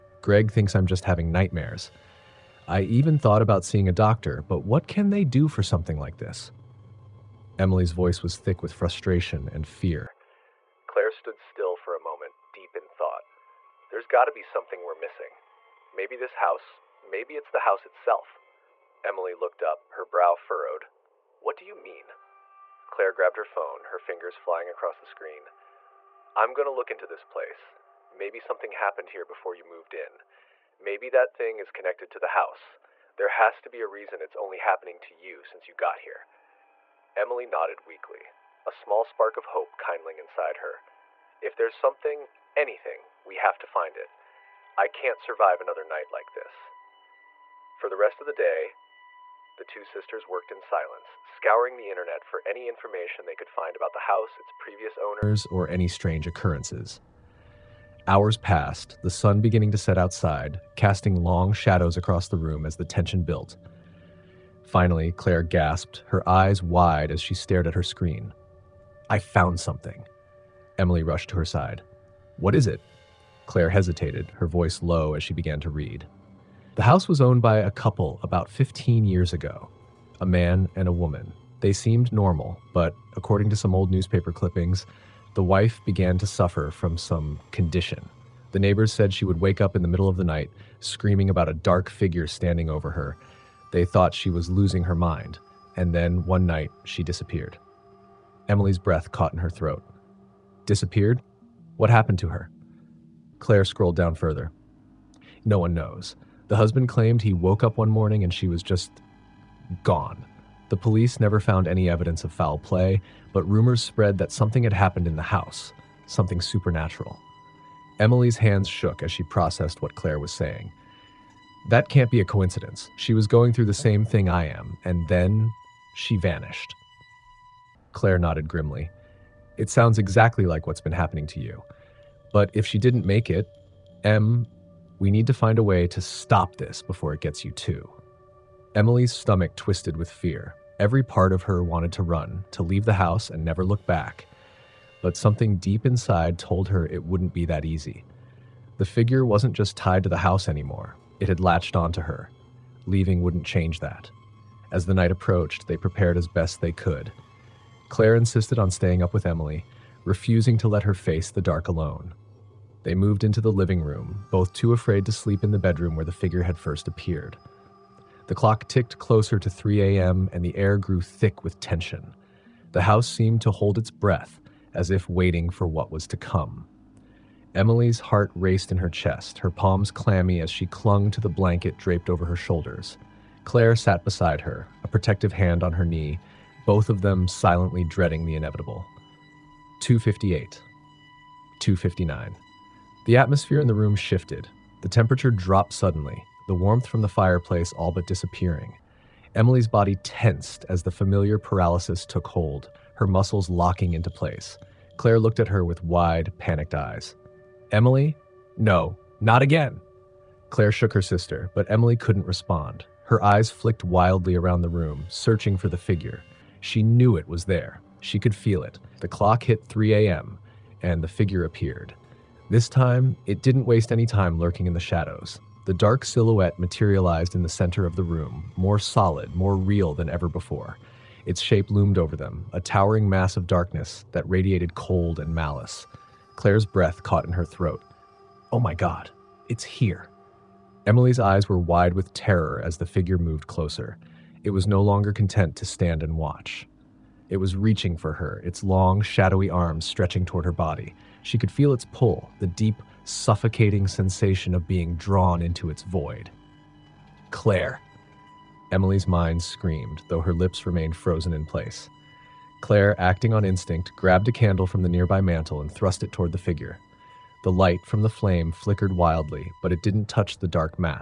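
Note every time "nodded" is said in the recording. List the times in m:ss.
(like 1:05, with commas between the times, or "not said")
0:37, 2:08.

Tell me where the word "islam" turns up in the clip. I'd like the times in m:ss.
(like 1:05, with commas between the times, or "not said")
not said.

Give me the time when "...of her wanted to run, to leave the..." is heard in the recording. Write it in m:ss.
2:21.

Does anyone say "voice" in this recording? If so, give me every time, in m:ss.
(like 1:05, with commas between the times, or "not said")
0:07, 1:14.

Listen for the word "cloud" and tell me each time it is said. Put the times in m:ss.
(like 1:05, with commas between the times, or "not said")
not said.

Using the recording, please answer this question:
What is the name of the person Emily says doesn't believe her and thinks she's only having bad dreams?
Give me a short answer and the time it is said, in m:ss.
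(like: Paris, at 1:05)
Greg, at 0:00.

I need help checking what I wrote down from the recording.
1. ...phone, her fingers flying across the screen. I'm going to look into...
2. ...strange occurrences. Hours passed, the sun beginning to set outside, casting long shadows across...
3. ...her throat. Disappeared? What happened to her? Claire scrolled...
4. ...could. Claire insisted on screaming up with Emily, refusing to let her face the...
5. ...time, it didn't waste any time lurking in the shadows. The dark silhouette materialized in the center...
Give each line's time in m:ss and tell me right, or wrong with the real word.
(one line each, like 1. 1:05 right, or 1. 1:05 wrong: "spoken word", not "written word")
1. 0:23 right
2. 0:55 right
3. 1:39 right
4. 2:36 wrong: "staying", not "screaming"
5. 3:42 right.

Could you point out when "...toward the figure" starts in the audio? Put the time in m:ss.
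4:26.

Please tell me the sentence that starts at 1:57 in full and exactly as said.
Emily's hands shook as she processed what Claire was saying.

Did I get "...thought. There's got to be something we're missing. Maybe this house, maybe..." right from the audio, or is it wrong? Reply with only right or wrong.
right.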